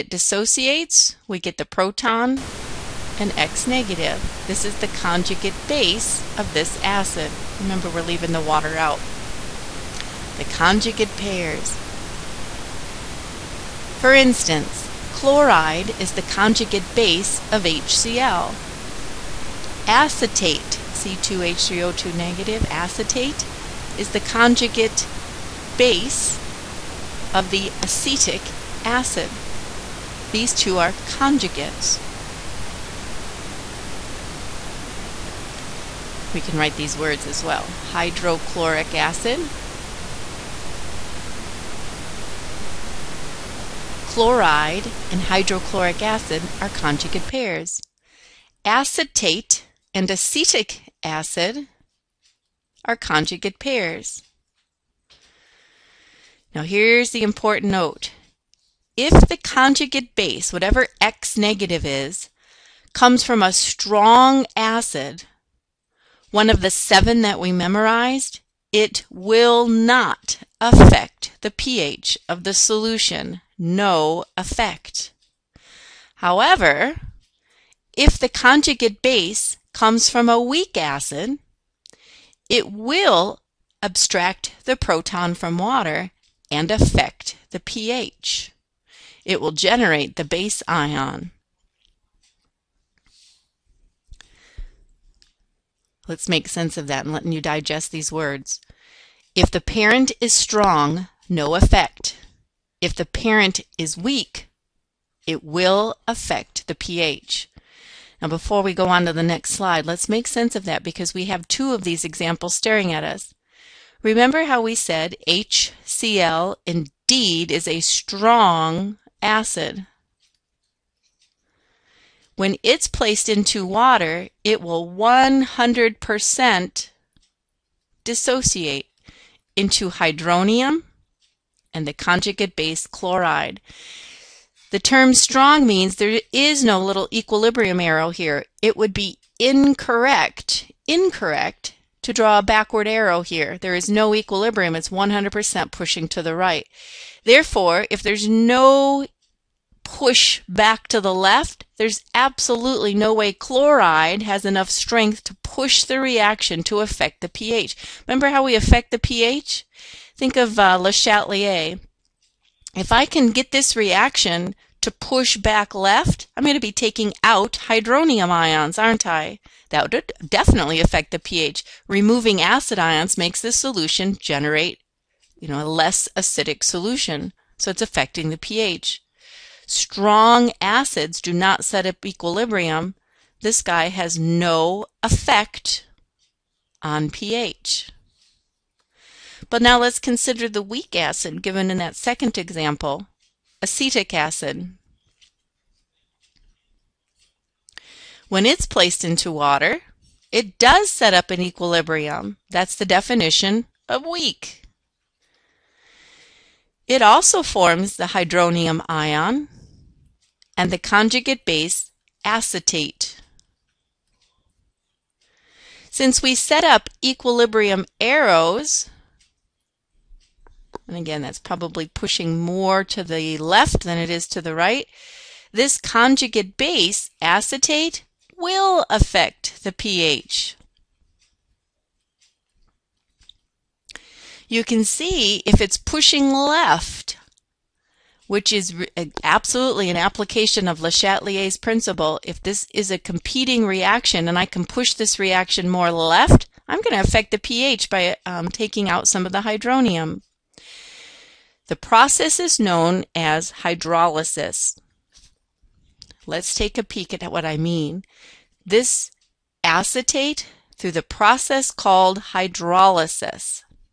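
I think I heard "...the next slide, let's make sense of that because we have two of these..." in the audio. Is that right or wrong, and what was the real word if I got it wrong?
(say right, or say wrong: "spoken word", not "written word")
right.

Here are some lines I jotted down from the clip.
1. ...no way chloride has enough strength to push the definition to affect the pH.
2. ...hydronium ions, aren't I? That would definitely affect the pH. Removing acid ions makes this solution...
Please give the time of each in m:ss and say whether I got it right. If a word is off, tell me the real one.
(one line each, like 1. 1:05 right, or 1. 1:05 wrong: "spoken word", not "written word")
1. 2:32 wrong: "reaction", not "definition"
2. 2:47 right.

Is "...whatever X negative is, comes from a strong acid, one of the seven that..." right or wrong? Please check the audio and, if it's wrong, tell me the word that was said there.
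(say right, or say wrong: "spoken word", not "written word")
right.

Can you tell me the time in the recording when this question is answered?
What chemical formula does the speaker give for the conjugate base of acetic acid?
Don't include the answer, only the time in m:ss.
0:20.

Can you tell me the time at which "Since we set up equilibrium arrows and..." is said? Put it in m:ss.
3:35.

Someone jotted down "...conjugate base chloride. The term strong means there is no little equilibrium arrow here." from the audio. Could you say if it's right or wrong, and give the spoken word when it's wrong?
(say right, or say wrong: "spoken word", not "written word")
right.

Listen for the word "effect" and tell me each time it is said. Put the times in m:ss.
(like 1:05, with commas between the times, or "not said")
1:14, 1:41, 3:05.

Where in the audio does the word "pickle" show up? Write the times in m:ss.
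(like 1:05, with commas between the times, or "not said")
not said.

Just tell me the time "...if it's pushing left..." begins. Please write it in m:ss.
3:55.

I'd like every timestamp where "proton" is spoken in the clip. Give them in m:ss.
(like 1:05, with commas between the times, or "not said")
0:01, 1:24.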